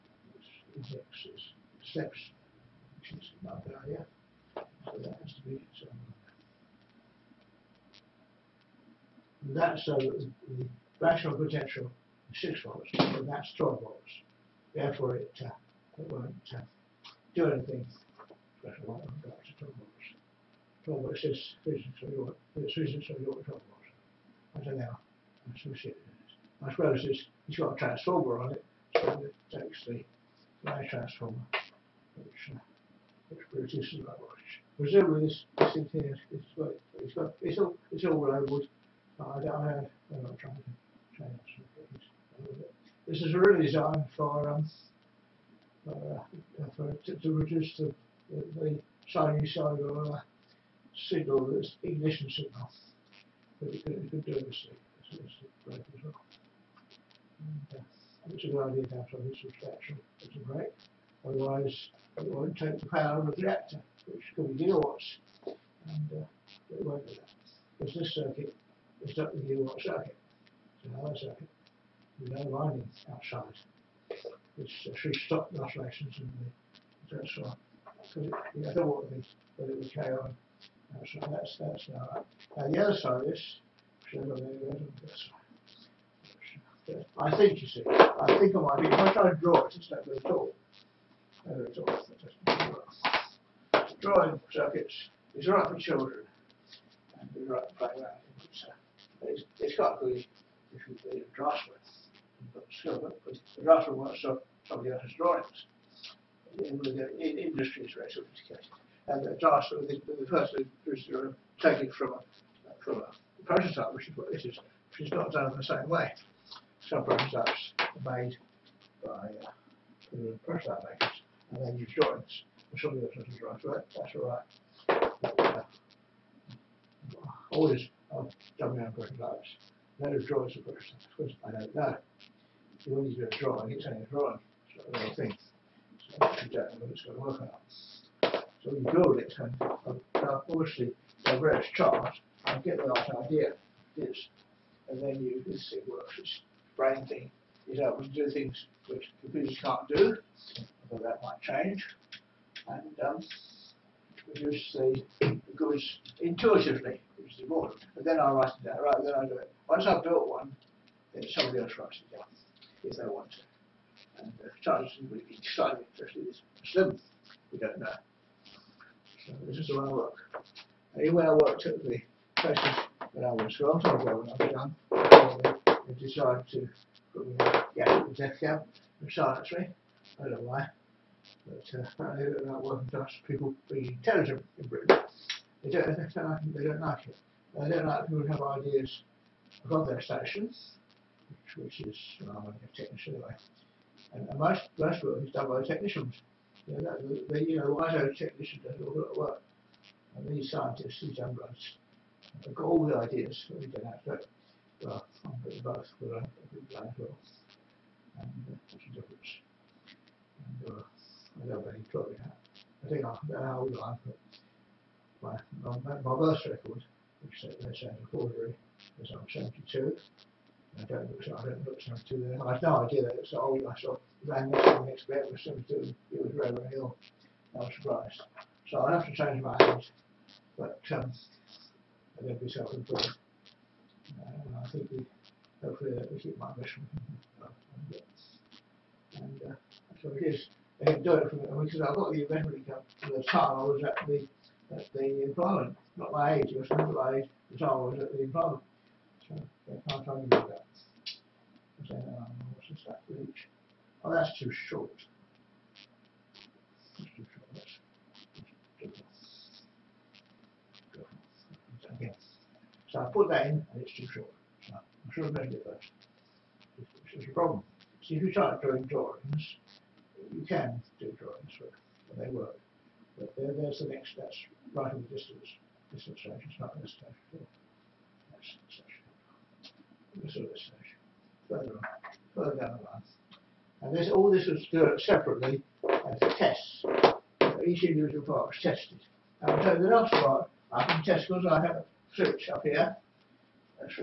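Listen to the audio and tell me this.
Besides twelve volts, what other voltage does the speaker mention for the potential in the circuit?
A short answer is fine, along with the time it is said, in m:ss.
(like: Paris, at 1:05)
6 volts, at 0:12.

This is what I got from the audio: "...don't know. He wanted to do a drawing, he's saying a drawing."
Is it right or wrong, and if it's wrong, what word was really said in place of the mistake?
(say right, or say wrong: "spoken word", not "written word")
right.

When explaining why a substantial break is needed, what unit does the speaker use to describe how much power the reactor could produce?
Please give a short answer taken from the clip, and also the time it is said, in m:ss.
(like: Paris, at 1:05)
gigawatts, at 1:04.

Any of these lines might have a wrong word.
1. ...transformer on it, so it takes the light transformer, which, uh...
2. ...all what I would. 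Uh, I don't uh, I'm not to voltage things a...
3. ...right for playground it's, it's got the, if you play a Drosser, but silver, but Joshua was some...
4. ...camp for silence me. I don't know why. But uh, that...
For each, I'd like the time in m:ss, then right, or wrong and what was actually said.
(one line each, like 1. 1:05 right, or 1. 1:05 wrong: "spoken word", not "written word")
1. 0:27 right
2. 0:38 wrong: "change", not "voltage"
3. 1:37 wrong: "Drosser", not "Joshua"
4. 2:58 right.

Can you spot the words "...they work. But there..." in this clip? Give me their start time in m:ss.
4:32.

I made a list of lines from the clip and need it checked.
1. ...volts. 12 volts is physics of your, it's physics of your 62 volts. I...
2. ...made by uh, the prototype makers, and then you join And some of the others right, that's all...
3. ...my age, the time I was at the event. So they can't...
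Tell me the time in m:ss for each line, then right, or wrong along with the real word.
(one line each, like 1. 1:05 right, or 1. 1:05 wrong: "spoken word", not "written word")
1. 0:19 wrong: "12", not "62"
2. 1:58 right
3. 4:06 wrong: "employment", not "event".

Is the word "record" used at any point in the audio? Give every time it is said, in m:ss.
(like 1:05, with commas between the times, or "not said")
3:36.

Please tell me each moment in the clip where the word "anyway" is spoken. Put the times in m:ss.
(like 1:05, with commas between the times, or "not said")
2:50, 3:13.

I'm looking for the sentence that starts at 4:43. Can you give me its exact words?
And this, all this was done separately as tests.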